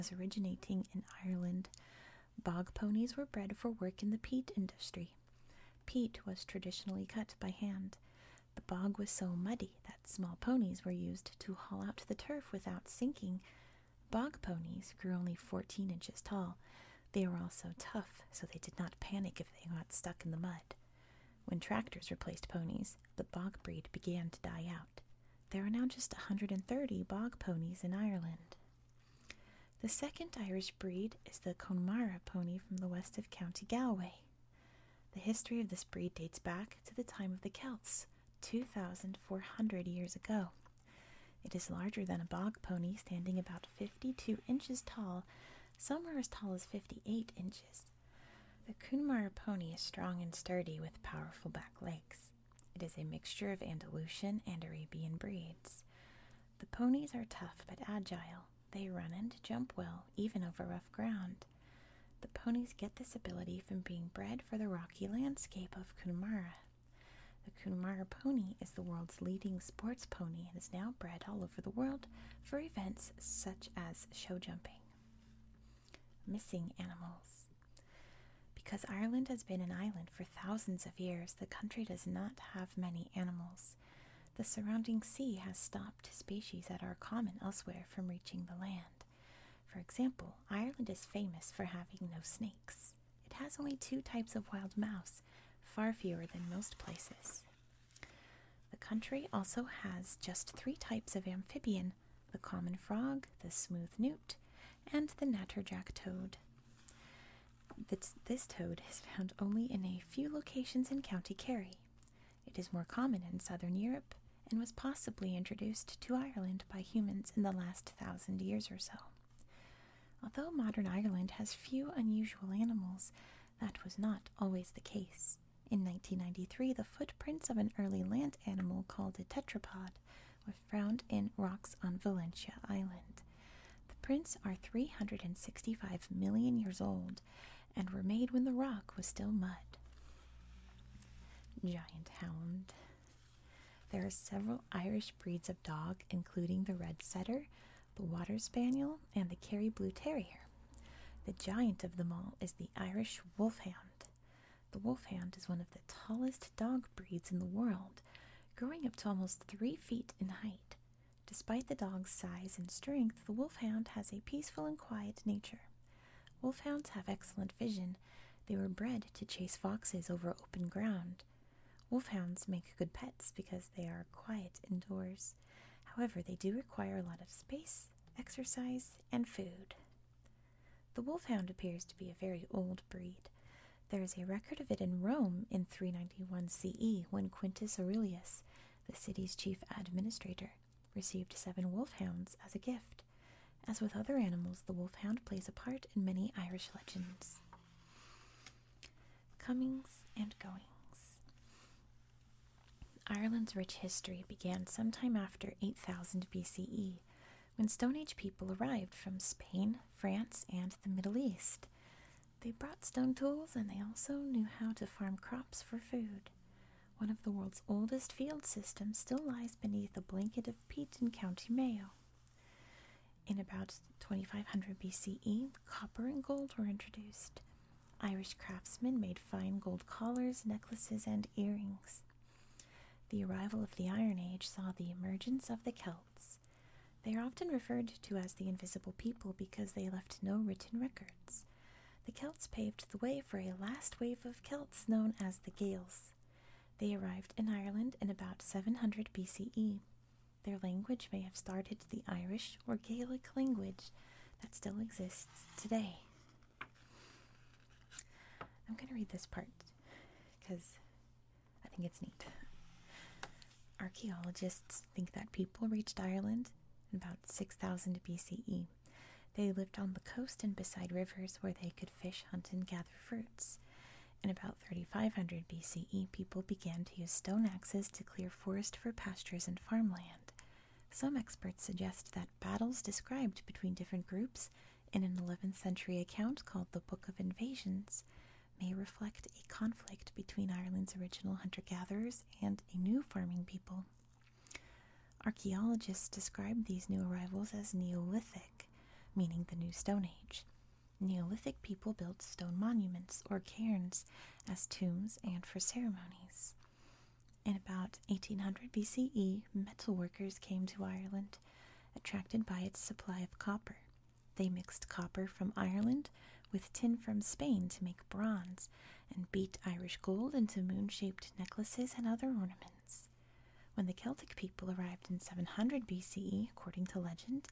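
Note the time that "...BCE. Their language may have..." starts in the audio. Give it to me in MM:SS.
04:09.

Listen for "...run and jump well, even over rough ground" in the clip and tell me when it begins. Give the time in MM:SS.
00:58.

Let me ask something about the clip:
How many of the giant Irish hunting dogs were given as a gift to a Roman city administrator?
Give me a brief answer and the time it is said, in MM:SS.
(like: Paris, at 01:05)
7, at 03:11.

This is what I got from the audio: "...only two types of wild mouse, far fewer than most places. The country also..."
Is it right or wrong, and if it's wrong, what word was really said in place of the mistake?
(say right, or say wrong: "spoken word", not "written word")
right.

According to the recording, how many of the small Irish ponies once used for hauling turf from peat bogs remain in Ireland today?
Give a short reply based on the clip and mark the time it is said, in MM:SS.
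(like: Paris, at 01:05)
130, at 00:26.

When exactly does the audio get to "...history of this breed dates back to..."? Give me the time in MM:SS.
00:35.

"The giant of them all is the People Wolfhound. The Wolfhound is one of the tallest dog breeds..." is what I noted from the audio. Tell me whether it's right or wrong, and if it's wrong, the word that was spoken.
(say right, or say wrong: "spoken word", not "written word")
wrong: "Irish", not "People".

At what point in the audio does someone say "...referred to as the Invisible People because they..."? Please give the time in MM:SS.
03:57.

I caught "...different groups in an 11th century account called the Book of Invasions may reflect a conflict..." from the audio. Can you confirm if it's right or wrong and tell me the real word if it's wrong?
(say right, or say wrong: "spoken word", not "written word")
right.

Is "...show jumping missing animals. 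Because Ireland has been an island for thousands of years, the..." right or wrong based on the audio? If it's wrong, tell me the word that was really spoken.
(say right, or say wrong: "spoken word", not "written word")
right.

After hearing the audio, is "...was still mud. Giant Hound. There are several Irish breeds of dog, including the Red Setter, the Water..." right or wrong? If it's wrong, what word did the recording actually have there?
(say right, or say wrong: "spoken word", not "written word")
right.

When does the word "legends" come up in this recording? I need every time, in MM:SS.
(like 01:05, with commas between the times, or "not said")
03:16, 05:26.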